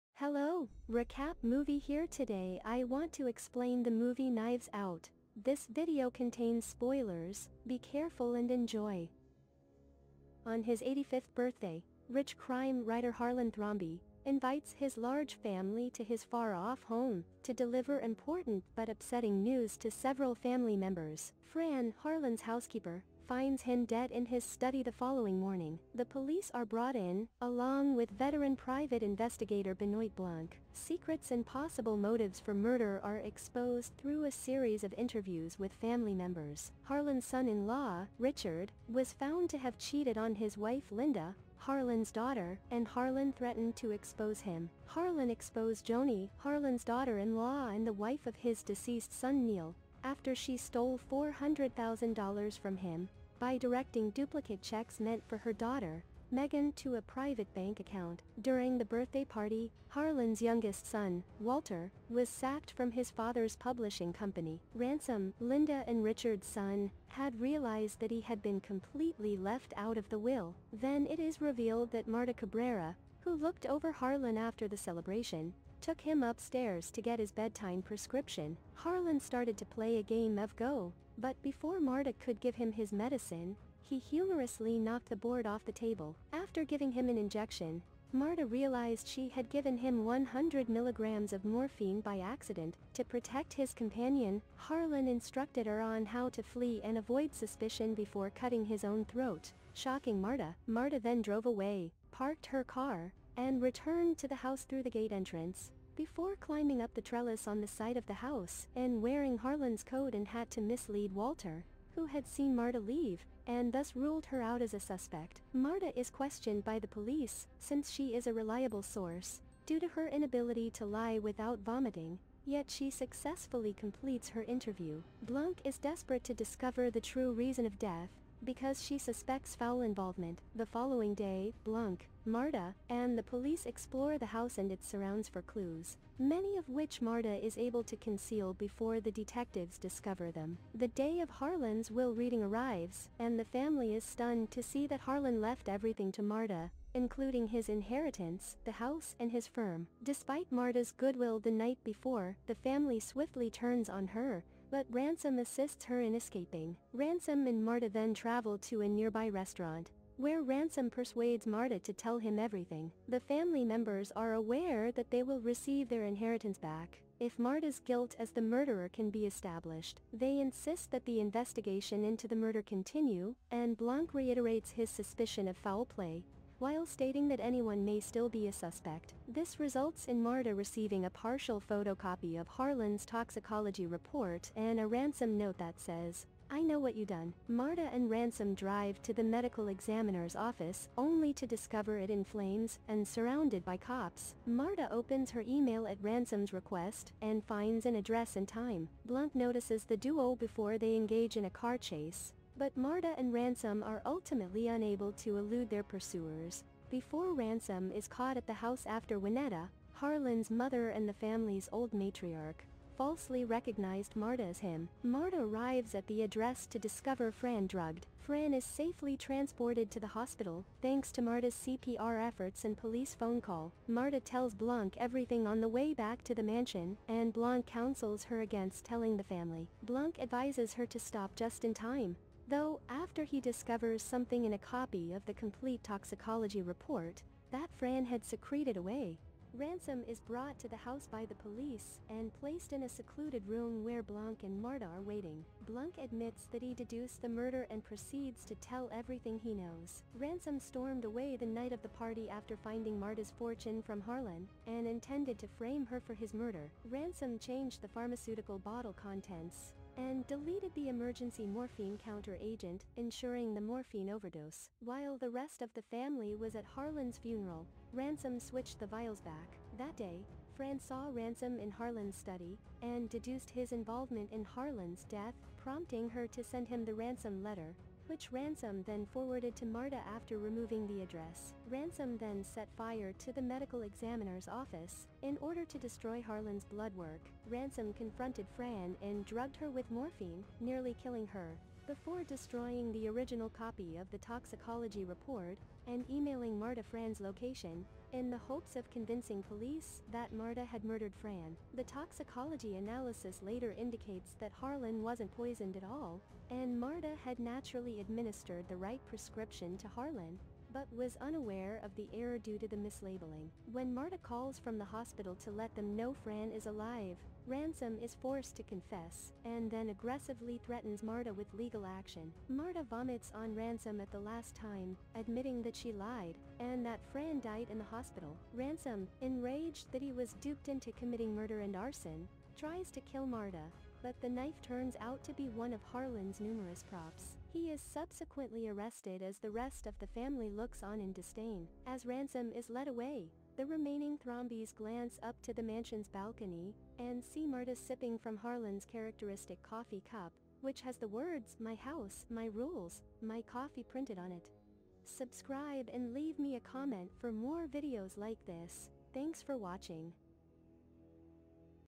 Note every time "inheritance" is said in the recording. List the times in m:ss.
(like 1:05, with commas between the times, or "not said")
2:27, 2:46.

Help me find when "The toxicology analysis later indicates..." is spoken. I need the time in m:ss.
5:01.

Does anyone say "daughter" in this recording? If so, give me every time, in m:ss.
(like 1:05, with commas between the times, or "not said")
0:42, 0:46, 0:55.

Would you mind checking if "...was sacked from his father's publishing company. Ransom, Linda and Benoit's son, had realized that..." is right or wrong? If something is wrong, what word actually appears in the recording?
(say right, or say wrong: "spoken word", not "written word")
wrong: "Richard", not "Benoit".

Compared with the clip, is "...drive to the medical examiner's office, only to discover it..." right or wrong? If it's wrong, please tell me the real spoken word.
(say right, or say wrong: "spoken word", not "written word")
right.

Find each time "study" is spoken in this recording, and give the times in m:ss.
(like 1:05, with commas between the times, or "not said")
0:24, 4:32.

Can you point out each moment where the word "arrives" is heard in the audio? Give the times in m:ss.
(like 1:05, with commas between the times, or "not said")
2:22, 3:35.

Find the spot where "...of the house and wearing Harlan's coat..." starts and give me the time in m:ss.
1:47.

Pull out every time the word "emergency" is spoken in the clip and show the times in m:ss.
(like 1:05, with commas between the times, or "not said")
4:20.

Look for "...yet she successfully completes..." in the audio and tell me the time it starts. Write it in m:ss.
2:02.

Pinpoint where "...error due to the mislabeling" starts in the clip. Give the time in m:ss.
5:12.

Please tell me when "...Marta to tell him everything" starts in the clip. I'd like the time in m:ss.
2:41.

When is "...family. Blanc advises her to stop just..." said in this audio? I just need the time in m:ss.
3:49.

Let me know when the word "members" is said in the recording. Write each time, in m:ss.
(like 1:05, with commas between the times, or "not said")
0:20, 0:36, 2:43.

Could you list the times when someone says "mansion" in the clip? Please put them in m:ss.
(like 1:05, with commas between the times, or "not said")
3:46, 5:45.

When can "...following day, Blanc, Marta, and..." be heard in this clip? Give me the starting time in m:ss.
2:10.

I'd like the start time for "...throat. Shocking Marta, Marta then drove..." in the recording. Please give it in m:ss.
1:39.